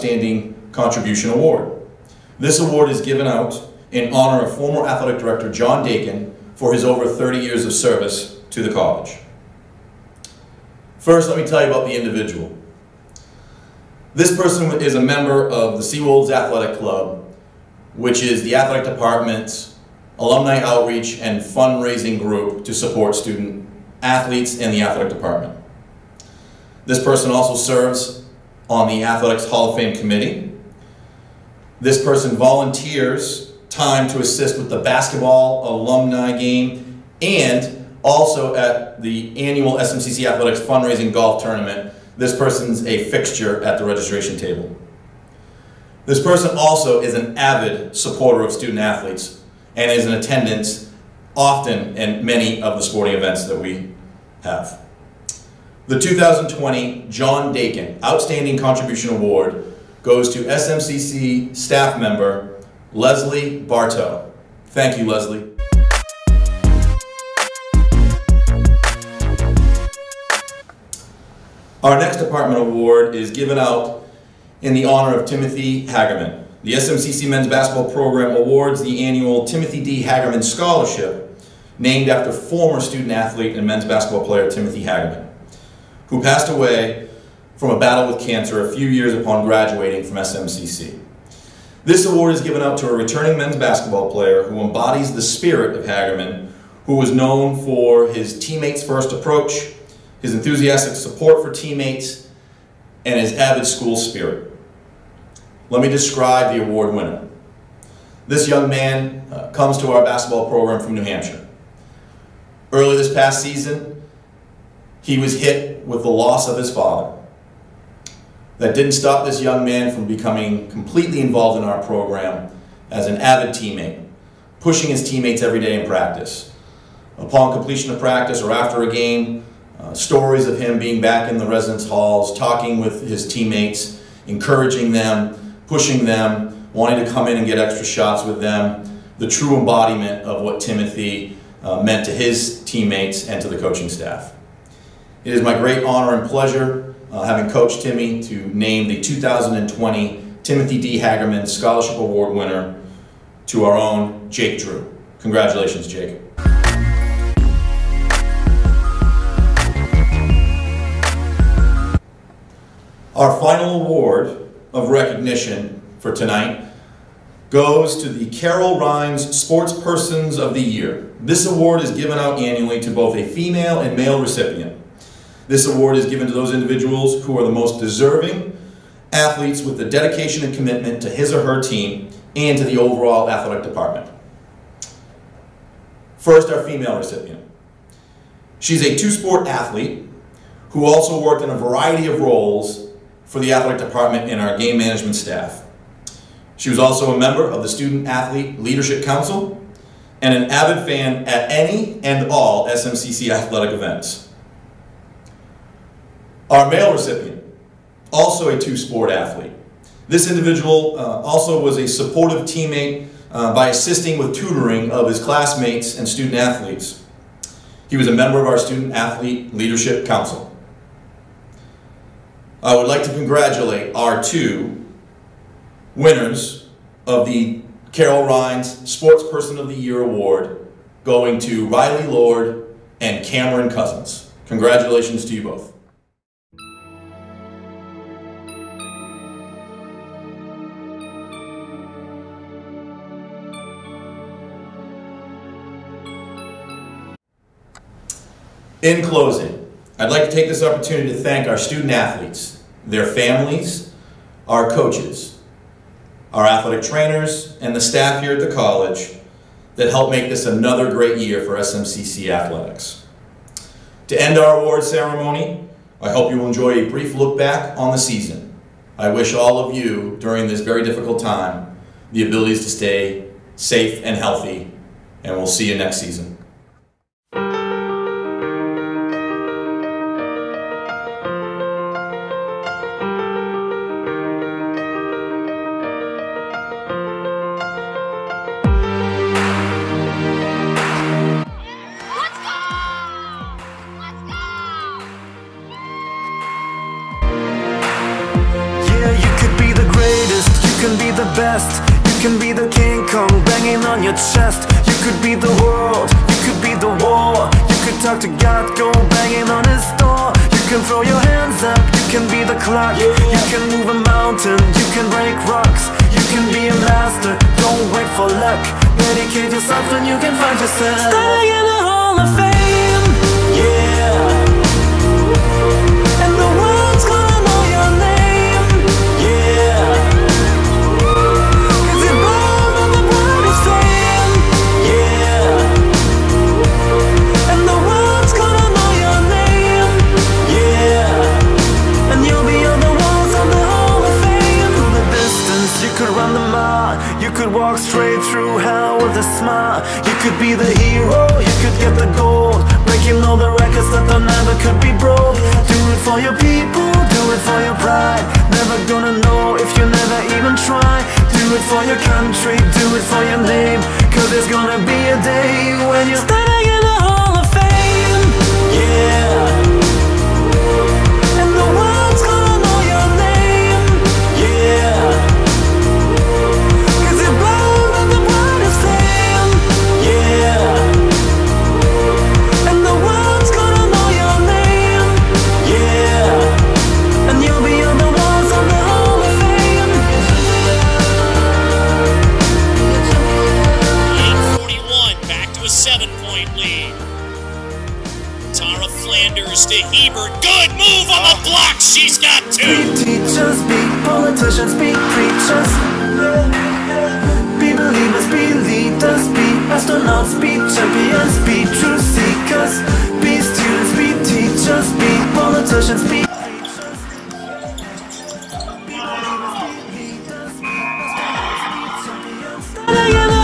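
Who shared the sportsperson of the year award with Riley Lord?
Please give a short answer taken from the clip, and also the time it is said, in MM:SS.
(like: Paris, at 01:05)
Cameron Cousins, at 03:53.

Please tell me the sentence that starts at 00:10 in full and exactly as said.
First, let me tell you about the individual.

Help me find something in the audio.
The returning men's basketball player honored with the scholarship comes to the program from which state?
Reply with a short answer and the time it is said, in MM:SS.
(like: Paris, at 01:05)
New Hampshire, at 01:50.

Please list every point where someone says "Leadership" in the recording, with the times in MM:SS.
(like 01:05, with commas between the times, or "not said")
03:18, 03:39.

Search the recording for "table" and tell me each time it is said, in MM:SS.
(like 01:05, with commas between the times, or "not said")
00:44.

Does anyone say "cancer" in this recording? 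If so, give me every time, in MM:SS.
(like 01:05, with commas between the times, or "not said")
01:28.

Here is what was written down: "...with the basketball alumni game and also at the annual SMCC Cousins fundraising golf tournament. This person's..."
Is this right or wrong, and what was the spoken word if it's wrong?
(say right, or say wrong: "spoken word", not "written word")
wrong: "Athletics", not "Cousins".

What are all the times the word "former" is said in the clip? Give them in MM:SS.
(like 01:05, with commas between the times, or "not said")
00:04, 01:22.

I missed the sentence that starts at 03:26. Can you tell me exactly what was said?
Our male recipient, also a two-sport athlete.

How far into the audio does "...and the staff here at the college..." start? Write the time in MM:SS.
04:17.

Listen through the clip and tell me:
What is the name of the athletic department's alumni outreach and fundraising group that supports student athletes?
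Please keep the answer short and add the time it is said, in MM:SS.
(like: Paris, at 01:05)
Seawolves Athletic Club, at 00:15.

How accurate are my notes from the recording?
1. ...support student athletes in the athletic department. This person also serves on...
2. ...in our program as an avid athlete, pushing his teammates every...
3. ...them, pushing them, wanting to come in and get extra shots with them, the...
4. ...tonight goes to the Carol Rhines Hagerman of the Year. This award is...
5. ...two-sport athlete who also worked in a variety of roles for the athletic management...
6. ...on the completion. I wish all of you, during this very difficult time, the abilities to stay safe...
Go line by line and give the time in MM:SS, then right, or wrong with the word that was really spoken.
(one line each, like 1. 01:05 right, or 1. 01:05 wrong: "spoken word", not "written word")
1. 00:22 right
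2. 02:01 wrong: "teammate", not "athlete"
3. 02:14 right
4. 02:46 wrong: "Sportspersons", not "Hagerman"
5. 03:08 wrong: "department", not "management"
6. 04:27 wrong: "season", not "completion".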